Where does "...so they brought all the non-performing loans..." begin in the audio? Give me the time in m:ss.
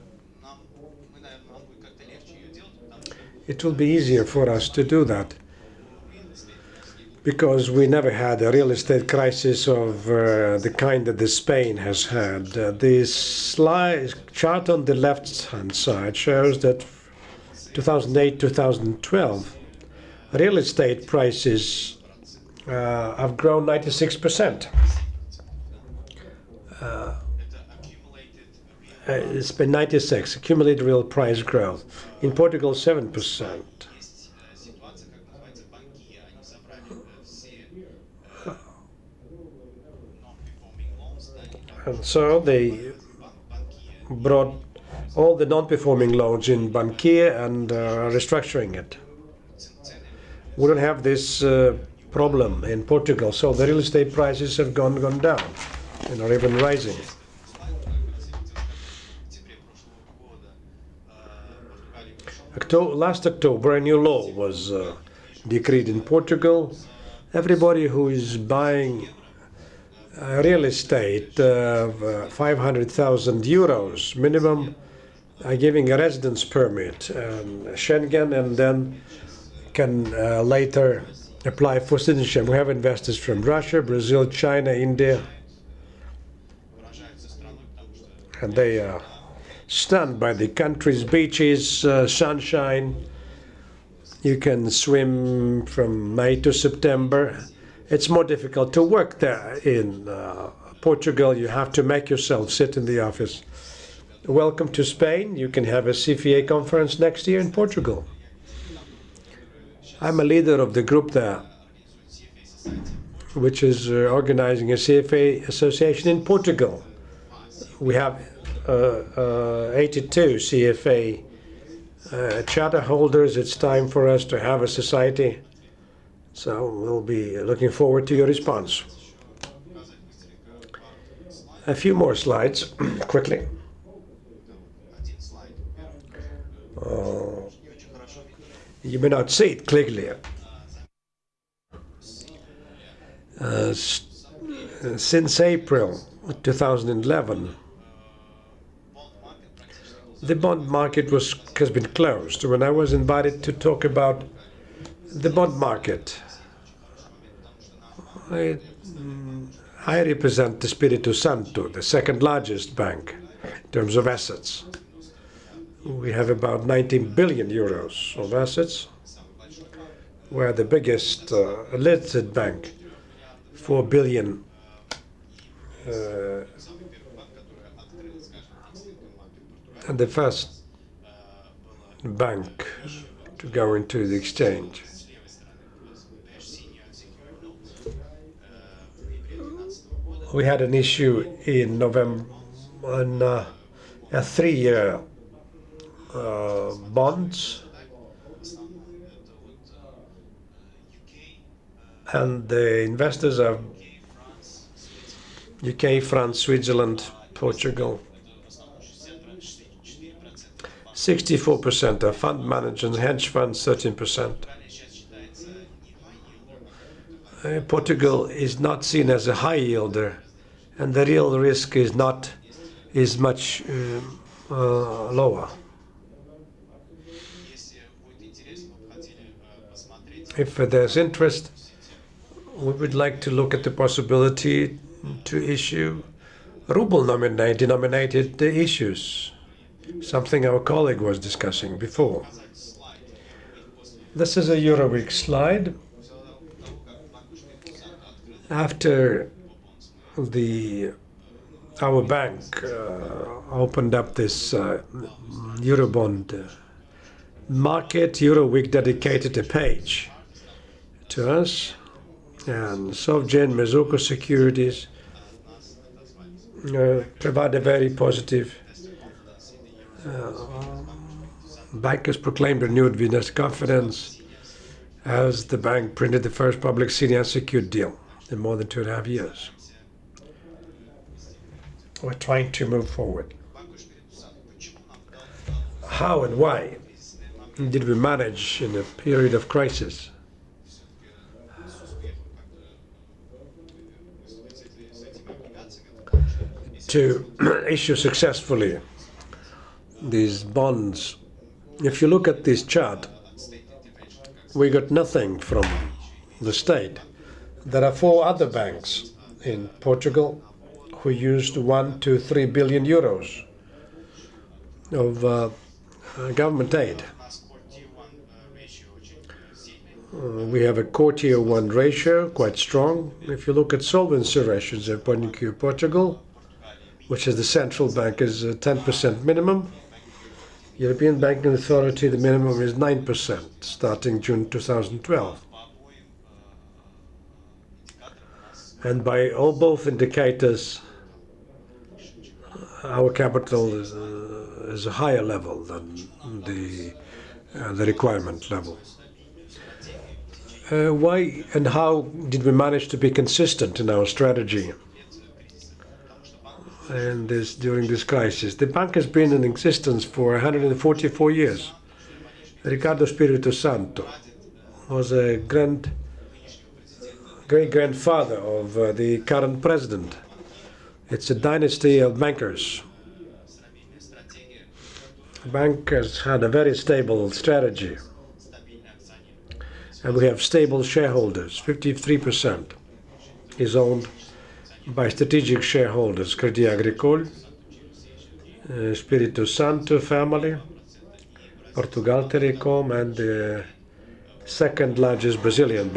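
0:42.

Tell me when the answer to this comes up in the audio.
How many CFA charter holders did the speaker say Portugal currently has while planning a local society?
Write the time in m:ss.
1:59.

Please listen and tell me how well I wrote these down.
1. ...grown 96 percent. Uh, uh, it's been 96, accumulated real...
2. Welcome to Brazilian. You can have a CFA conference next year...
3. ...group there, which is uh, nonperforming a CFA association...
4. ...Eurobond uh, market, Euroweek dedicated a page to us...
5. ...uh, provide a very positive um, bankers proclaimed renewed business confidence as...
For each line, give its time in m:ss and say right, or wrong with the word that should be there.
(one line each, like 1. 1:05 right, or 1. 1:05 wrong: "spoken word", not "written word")
1. 0:23 right
2. 1:44 wrong: "Spain", not "Brazilian"
3. 1:50 wrong: "organizing", not "nonperforming"
4. 4:15 right
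5. 4:26 right.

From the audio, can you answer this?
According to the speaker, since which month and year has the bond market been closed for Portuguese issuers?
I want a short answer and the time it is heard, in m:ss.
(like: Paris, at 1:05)
April 2011, at 2:25.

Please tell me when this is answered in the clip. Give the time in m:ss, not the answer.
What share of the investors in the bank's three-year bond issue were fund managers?
3:30.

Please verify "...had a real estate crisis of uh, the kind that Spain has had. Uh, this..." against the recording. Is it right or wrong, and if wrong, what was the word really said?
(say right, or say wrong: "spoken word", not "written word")
right.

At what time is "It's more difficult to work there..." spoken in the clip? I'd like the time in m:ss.
1:37.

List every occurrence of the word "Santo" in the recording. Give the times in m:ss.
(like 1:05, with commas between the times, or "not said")
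2:41, 6:03, 6:29.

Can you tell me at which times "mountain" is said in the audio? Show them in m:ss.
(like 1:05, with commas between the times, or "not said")
not said.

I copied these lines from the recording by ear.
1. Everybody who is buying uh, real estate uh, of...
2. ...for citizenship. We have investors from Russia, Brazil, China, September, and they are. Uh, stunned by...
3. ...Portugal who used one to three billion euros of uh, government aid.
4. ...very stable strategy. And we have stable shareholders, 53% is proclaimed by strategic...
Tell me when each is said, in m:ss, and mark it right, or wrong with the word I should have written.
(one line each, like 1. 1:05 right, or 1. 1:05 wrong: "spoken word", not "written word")
1. 1:07 right
2. 1:21 wrong: "India", not "September"
3. 5:09 right
4. 6:16 wrong: "owned", not "proclaimed".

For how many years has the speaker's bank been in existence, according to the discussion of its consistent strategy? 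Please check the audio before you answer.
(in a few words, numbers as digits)
144 years.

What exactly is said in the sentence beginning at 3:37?
Uh, Portugal is not seen as a high yielder, and the real risk is not is much um, uh, lower.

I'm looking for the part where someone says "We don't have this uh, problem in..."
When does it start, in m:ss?
0:50.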